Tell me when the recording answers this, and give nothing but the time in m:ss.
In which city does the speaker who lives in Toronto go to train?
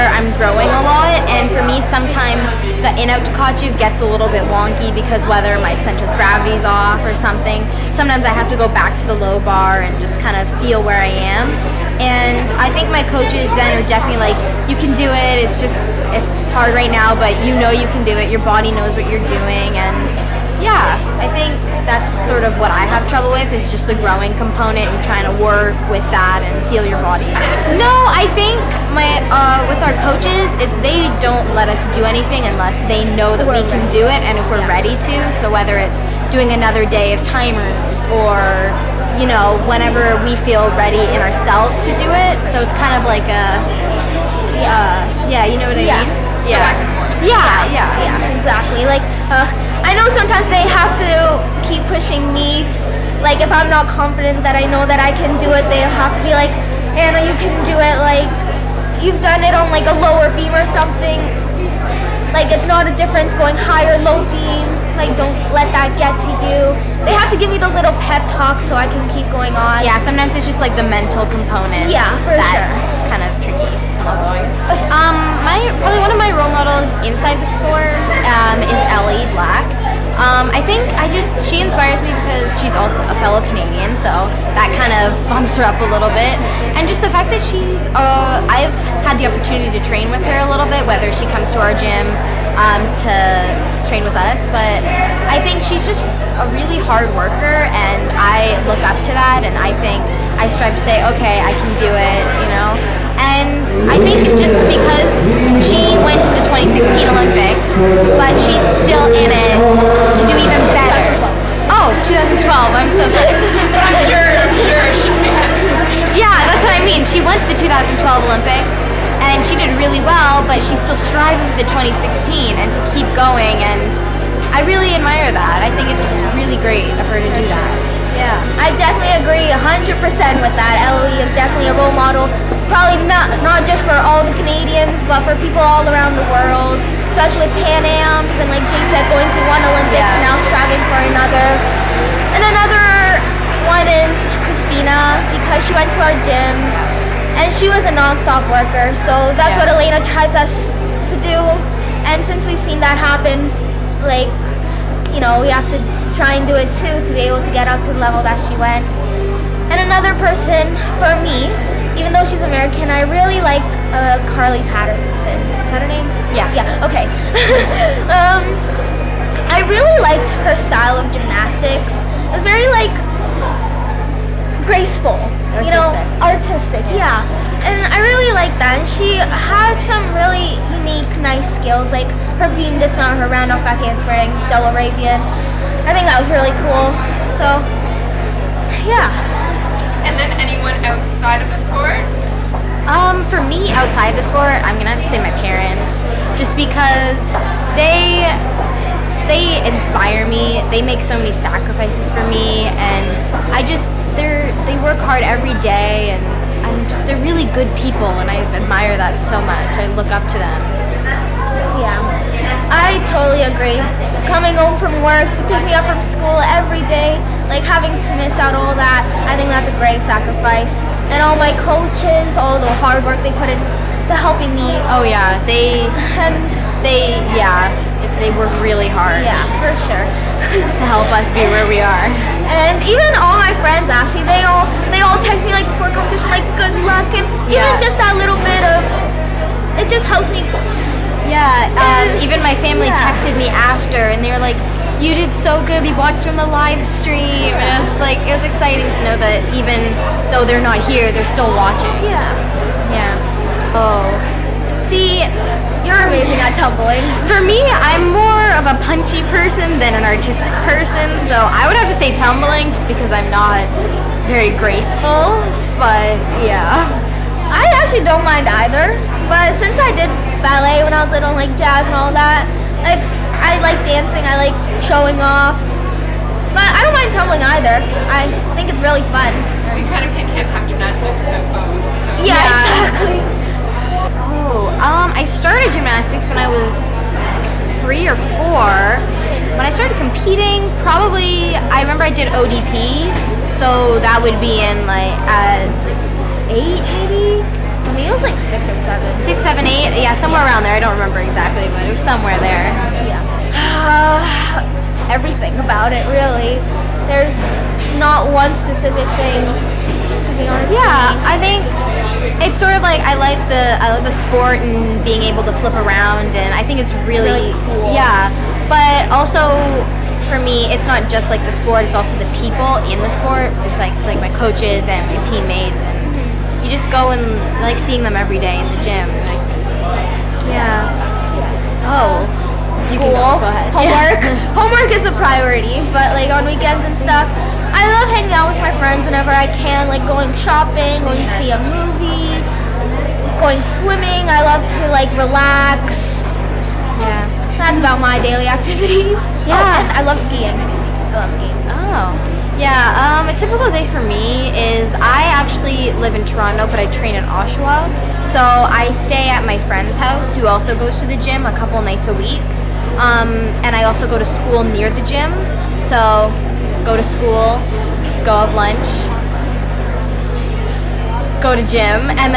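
5:57.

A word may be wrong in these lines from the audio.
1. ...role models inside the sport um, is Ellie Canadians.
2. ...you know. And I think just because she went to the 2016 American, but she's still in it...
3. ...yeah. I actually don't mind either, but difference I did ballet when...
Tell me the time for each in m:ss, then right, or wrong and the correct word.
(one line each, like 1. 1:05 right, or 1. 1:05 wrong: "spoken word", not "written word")
1. 1:16 wrong: "Black", not "Canadians"
2. 1:42 wrong: "Olympics", not "American"
3. 4:26 wrong: "since", not "difference".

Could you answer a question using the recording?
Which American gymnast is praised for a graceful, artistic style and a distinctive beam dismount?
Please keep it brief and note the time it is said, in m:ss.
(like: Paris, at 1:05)
Carly Patterson, at 2:44.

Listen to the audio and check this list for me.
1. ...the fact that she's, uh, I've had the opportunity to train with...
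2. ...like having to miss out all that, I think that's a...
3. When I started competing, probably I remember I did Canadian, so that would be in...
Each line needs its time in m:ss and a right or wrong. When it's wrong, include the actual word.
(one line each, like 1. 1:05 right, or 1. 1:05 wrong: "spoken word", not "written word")
1. 1:26 right
2. 3:37 right
3. 4:49 wrong: "ODP", not "Canadian".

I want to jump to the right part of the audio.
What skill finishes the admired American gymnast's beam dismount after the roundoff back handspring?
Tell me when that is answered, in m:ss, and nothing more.
3:04.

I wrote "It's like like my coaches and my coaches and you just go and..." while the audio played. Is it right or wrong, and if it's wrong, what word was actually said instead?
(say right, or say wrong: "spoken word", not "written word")
wrong: "teammates", not "coaches".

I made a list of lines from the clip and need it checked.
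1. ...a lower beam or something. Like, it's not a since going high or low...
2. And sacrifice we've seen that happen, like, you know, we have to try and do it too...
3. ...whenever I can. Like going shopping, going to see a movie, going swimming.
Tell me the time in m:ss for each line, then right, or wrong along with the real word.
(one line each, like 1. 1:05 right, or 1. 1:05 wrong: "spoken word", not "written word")
1. 0:59 wrong: "difference", not "since"
2. 2:32 wrong: "since", not "sacrifice"
3. 5:39 right.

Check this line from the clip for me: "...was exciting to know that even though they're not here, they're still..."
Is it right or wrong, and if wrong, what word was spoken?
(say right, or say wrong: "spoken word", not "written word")
right.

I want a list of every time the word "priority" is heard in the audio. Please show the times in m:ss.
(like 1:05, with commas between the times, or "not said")
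5:35.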